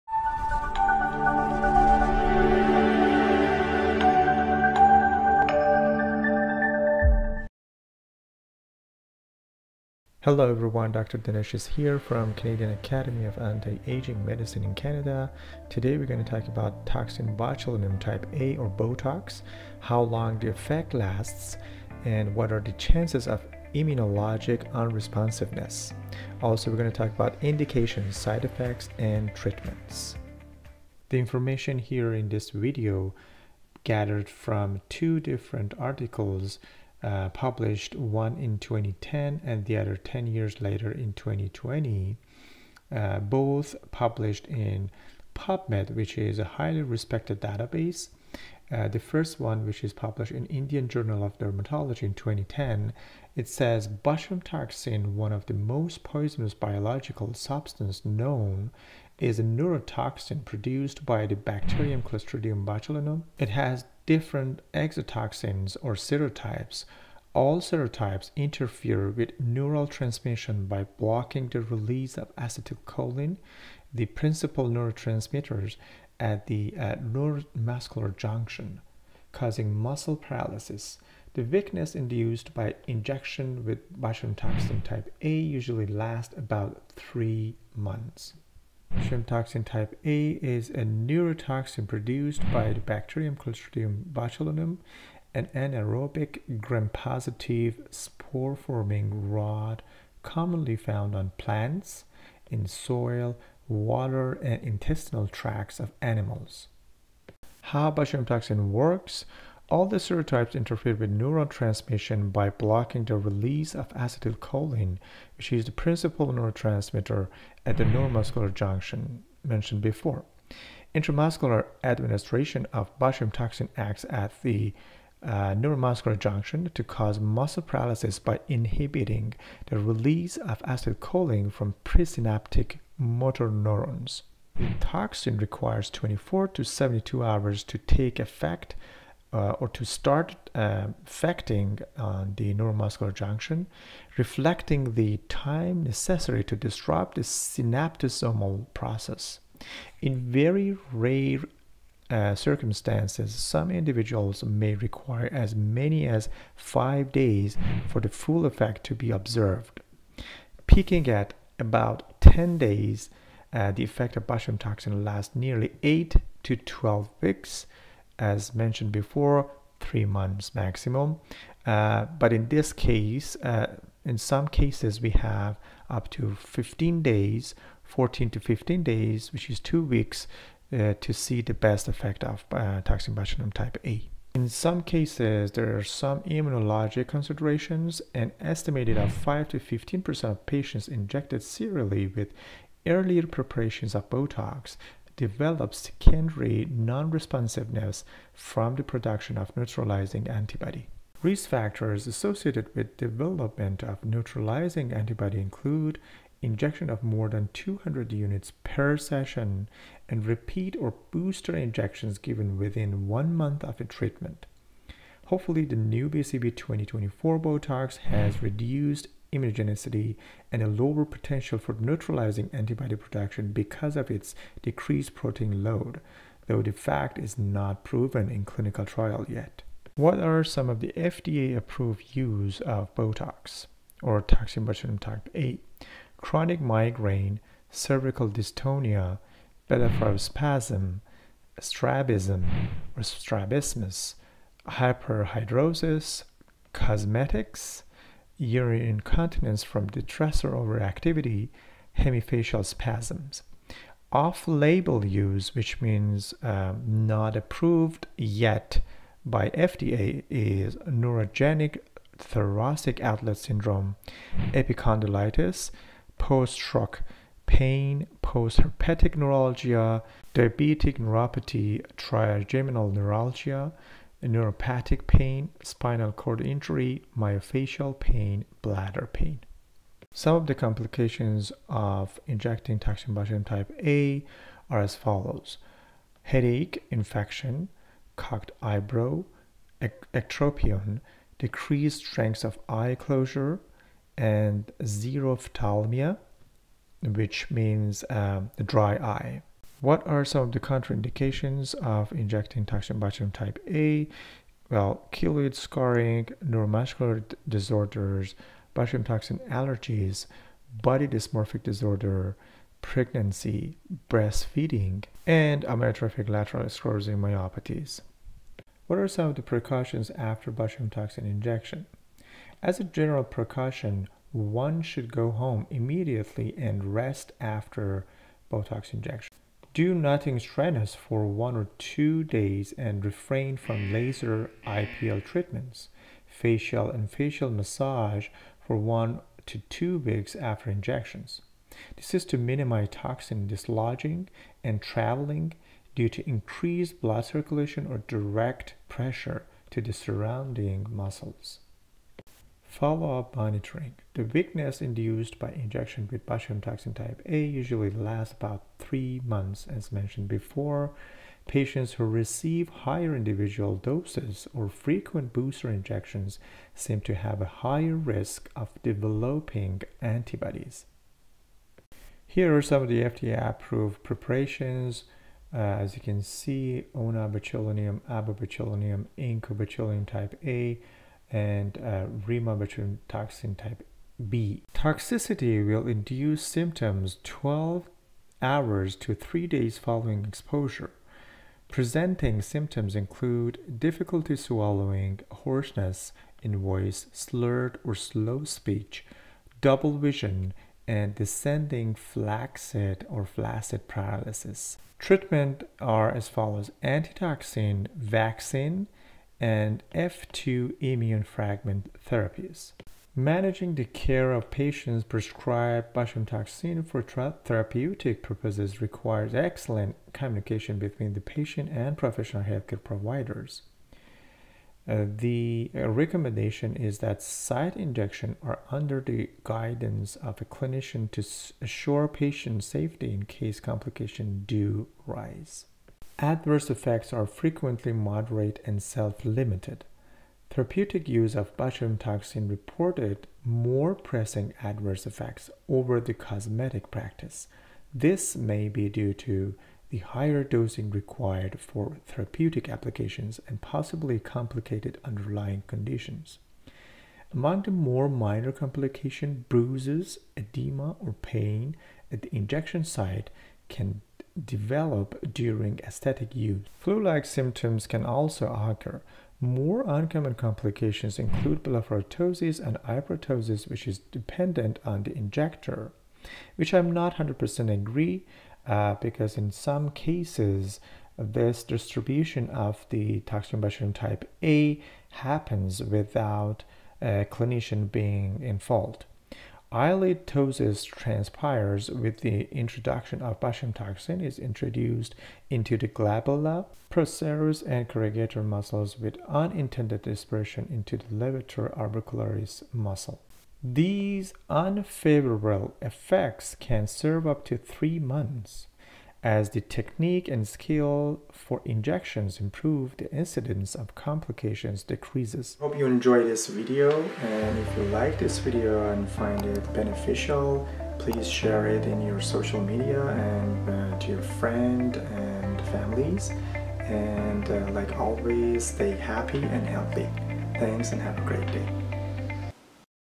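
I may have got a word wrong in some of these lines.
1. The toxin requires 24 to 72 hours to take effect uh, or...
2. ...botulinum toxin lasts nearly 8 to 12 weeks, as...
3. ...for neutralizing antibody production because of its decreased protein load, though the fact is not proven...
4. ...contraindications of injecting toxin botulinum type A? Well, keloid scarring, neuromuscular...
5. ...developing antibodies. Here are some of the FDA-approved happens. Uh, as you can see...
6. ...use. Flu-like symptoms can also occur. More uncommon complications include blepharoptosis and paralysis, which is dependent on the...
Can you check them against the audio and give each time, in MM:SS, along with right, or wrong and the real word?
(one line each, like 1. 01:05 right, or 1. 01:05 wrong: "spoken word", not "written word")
1. 02:14 right
2. 02:44 right
3. 03:41 right
4. 05:00 right
5. 06:08 wrong: "preparations", not "happens"
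6. 07:46 wrong: "hypertosis", not "paralysis".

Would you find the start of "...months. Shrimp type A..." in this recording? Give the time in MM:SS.
01:27.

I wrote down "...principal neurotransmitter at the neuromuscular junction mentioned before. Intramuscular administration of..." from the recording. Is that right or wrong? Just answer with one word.
right.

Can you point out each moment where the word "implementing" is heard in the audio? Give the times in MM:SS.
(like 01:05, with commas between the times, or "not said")
not said.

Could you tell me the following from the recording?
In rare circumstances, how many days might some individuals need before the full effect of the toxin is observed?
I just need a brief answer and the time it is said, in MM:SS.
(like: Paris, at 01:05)
5 days, at 02:36.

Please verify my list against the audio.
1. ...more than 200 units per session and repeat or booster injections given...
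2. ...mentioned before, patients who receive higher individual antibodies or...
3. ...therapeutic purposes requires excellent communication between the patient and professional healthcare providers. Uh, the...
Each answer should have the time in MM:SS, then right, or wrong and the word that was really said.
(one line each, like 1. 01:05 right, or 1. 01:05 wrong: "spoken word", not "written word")
1. 03:27 right
2. 05:59 wrong: "doses", not "antibodies"
3. 06:57 right.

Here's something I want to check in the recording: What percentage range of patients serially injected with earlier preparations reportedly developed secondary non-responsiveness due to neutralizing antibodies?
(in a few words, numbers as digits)
5 to 15%.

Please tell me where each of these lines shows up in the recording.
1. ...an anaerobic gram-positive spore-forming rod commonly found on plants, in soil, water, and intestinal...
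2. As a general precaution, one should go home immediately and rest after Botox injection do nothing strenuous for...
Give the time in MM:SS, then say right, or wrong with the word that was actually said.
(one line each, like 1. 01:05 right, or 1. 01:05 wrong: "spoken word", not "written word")
1. 01:35 right
2. 05:22 right.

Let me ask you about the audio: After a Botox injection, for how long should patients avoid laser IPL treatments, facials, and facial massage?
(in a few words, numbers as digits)
1 to 2 weeks.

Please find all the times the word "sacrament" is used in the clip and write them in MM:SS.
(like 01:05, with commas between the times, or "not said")
not said.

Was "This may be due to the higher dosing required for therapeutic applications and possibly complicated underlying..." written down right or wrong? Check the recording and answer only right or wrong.
right.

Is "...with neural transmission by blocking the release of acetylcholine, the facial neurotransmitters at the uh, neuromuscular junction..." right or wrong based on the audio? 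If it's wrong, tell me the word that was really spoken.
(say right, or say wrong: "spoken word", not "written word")
wrong: "principal", not "facial".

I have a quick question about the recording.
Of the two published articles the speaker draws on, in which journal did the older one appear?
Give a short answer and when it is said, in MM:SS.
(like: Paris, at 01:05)
Indian Journal of Dermatology, at 00:50.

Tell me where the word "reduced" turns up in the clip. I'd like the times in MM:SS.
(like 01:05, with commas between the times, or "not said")
03:38.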